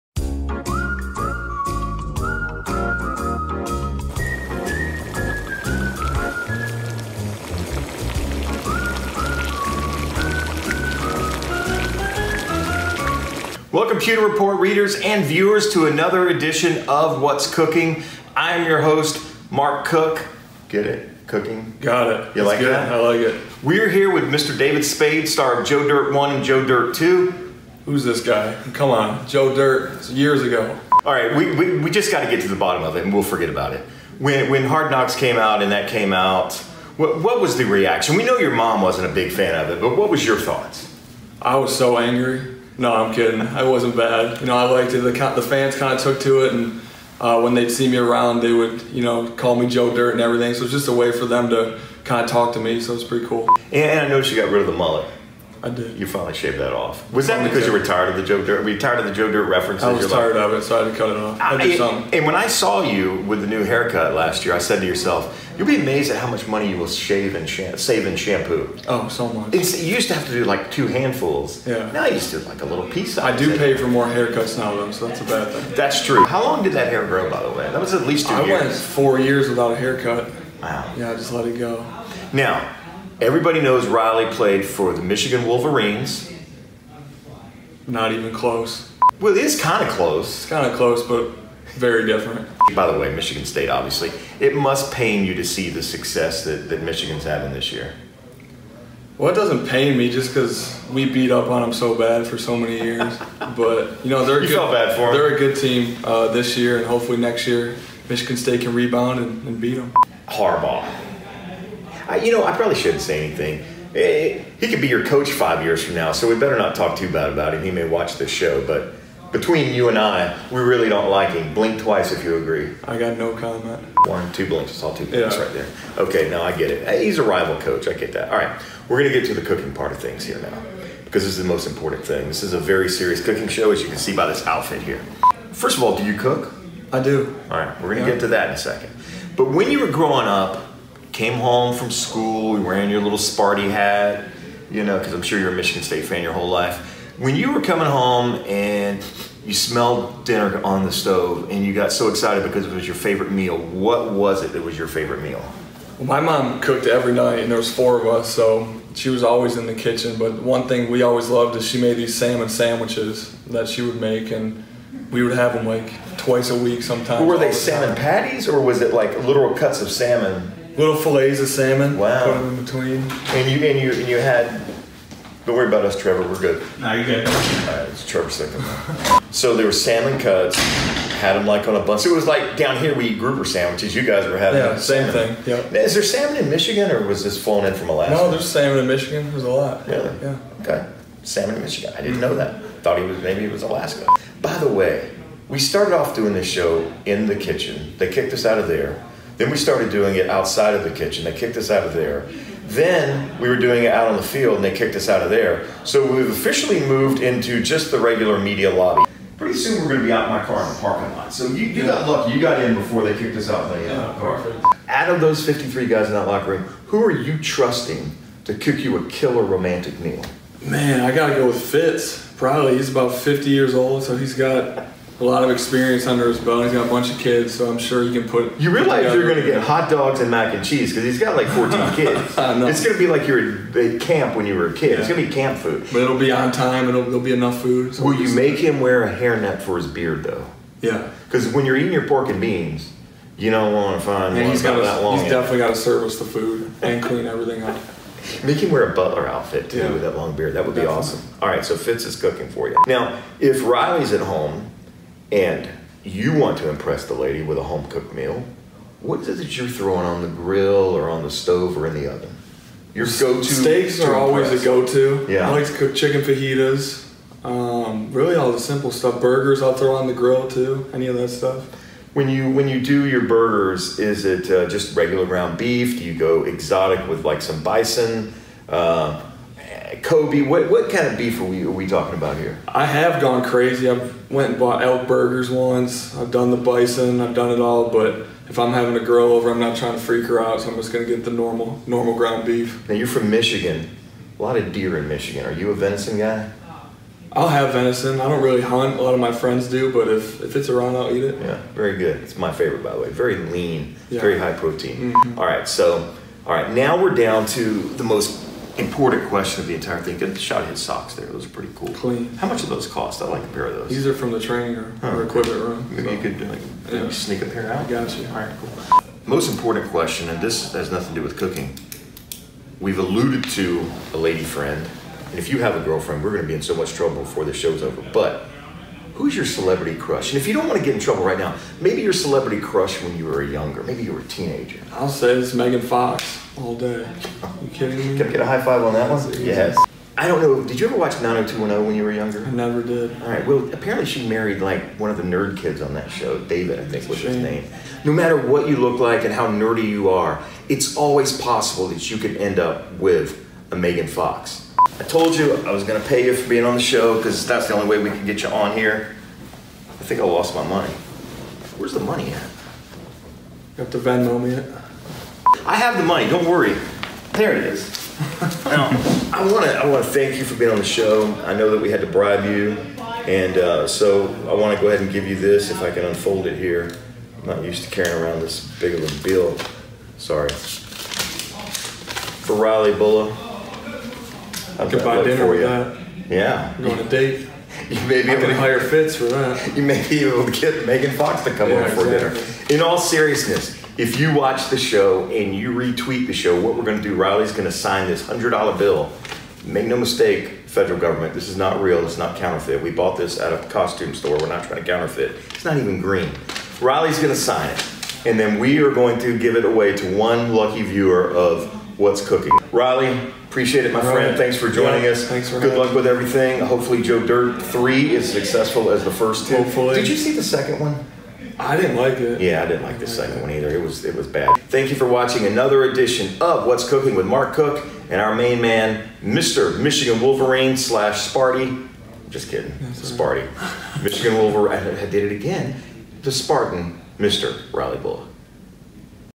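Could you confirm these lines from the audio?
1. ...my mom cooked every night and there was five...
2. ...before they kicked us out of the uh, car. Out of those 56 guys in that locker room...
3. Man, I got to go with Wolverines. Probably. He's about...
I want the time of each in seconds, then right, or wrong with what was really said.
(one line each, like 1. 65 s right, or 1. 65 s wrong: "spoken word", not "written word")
1. 156 s wrong: "four", not "five"
2. 212 s wrong: "53", not "56"
3. 220 s wrong: "Fitz", not "Wolverines".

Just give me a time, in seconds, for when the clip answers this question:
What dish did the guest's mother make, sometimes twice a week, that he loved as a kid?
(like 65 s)
162 s.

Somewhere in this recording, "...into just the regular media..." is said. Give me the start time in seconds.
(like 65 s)
207 s.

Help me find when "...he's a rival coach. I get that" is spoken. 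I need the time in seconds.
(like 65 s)
127 s.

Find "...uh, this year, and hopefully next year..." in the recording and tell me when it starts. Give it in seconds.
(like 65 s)
106 s.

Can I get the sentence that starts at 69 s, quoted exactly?
It's, you used to have to do like two handfuls.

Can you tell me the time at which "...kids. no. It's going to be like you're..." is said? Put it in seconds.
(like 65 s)
231 s.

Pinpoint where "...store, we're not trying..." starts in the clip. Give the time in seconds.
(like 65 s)
404 s.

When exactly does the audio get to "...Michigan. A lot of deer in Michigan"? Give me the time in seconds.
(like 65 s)
293 s.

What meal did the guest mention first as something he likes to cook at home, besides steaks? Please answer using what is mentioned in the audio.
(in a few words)
Chicken fajitas.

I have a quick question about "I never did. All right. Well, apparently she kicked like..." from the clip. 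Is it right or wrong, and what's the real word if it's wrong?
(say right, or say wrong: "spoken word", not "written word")
wrong: "married", not "kicked".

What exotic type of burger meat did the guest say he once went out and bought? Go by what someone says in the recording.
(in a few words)
Elk.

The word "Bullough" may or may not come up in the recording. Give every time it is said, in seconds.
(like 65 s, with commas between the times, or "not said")
382 s, 437 s.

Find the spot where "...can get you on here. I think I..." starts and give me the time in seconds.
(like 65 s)
358 s.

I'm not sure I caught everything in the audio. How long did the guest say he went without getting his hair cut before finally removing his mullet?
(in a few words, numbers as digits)
4 years.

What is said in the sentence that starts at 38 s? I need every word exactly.
We know your mom wasn't a big fan of it, but what was your thoughts?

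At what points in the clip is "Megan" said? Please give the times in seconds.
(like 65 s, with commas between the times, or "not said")
335 s, 353 s, 390 s.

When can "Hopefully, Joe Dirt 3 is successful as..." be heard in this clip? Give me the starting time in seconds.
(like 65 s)
416 s.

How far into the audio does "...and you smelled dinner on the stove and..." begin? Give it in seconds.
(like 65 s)
148 s.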